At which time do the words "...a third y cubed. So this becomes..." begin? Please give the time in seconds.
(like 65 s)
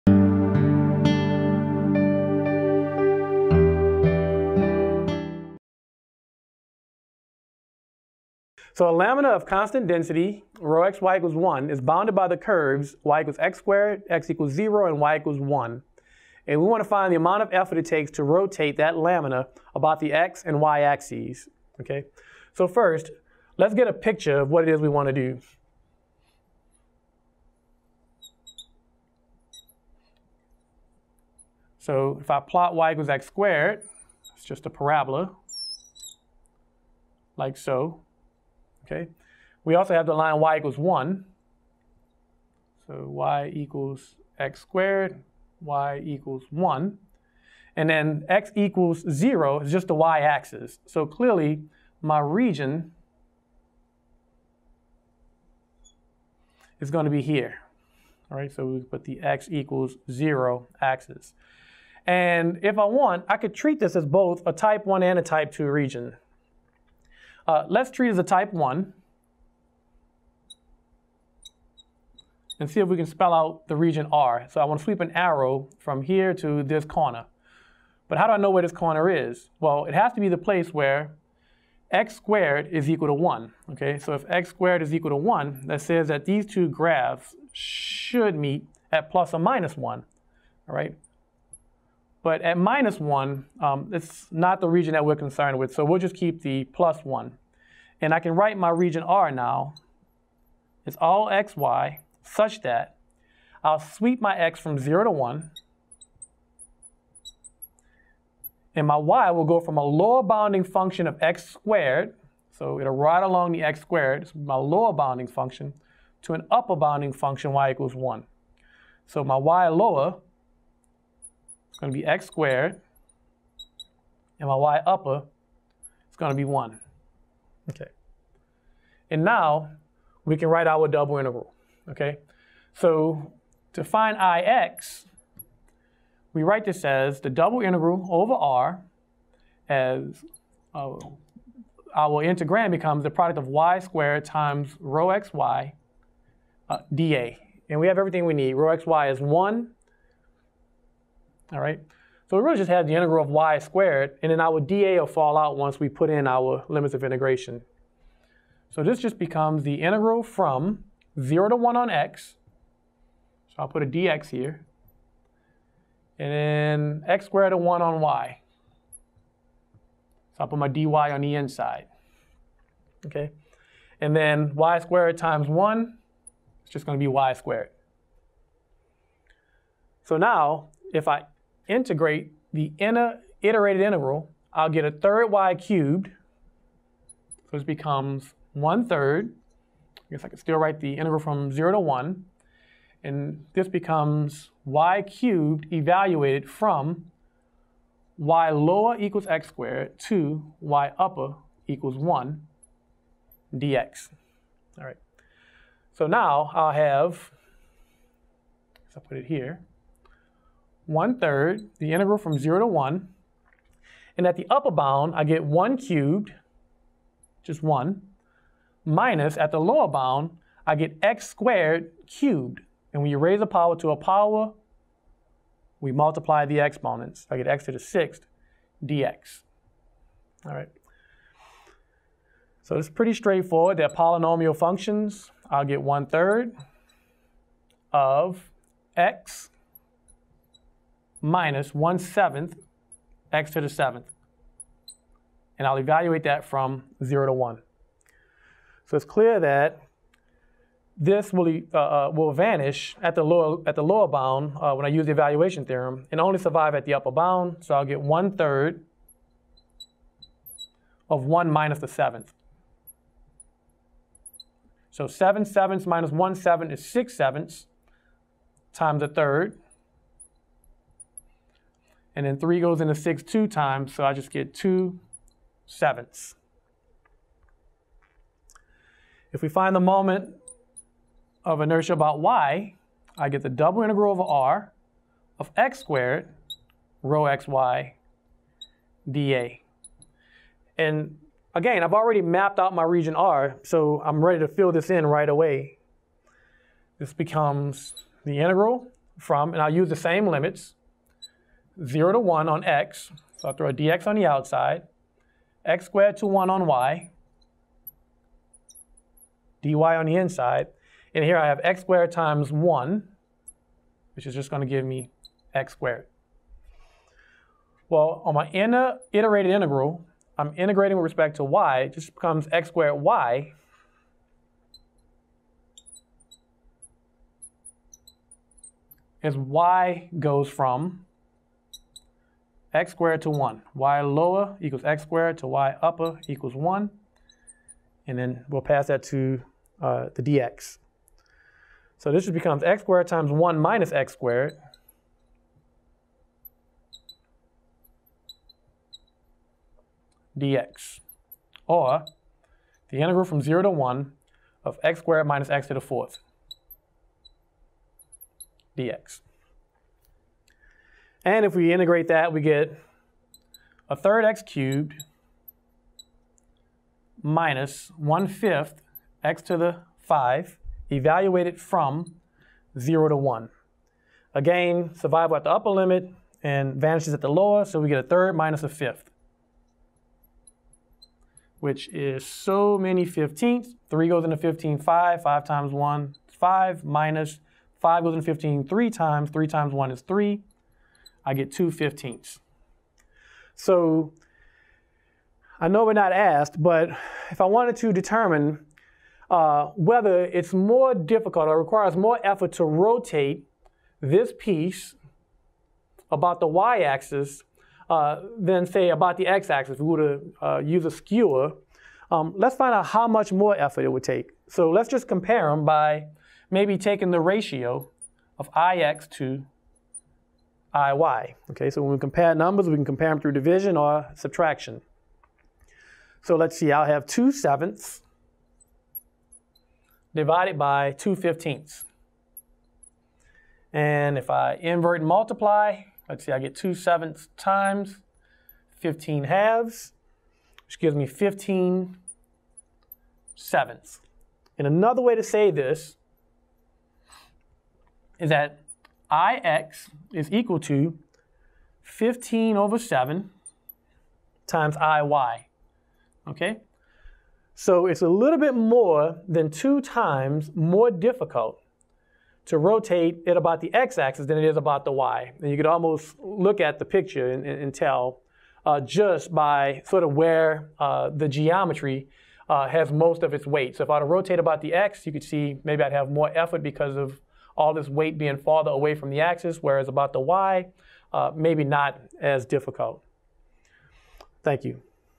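184 s.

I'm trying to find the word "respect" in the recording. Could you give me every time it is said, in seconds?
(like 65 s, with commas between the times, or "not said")
321 s.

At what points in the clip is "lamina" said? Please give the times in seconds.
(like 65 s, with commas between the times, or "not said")
8 s, 18 s.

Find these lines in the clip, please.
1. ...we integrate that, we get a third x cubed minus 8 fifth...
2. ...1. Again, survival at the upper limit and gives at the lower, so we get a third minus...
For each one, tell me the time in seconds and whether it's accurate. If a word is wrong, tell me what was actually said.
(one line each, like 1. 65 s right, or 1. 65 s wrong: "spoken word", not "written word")
1. 361 s wrong: "1", not "8"
2. 373 s wrong: "vanishes", not "gives".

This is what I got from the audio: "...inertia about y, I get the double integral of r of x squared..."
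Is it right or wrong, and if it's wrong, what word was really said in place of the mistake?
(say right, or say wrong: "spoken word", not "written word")
right.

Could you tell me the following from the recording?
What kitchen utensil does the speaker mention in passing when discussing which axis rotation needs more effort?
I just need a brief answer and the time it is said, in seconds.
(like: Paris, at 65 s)
a skewer, at 410 s.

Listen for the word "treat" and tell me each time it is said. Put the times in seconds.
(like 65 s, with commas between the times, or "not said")
63 s, 67 s.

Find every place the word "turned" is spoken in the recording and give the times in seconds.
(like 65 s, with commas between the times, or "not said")
not said.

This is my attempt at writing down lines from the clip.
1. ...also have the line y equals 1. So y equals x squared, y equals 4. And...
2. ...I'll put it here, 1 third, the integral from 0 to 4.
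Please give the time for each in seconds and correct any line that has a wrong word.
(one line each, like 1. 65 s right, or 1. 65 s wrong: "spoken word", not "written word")
1. 39 s wrong: "1", not "4"
2. 209 s wrong: "1", not "4".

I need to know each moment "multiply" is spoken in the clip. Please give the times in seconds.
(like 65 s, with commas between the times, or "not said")
225 s, 435 s.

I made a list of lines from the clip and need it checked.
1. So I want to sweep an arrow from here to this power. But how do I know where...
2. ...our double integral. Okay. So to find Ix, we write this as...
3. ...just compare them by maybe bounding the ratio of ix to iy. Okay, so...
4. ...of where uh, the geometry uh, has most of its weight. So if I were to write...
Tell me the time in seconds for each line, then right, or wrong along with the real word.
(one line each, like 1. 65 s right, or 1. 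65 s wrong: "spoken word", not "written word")
1. 74 s wrong: "corner", not "power"
2. 130 s right
3. 414 s wrong: "taking", not "bounding"
4. 470 s wrong: "rotate", not "write".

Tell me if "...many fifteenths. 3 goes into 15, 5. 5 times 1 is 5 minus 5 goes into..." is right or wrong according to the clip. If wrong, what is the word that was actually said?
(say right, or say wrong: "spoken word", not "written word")
right.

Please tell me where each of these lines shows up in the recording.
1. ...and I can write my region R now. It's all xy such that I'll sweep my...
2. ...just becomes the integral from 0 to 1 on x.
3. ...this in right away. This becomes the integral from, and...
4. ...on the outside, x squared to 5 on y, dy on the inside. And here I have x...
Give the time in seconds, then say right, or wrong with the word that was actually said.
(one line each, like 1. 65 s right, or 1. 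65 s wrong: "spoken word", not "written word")
1. 98 s right
2. 158 s right
3. 294 s right
4. 304 s wrong: "1", not "5".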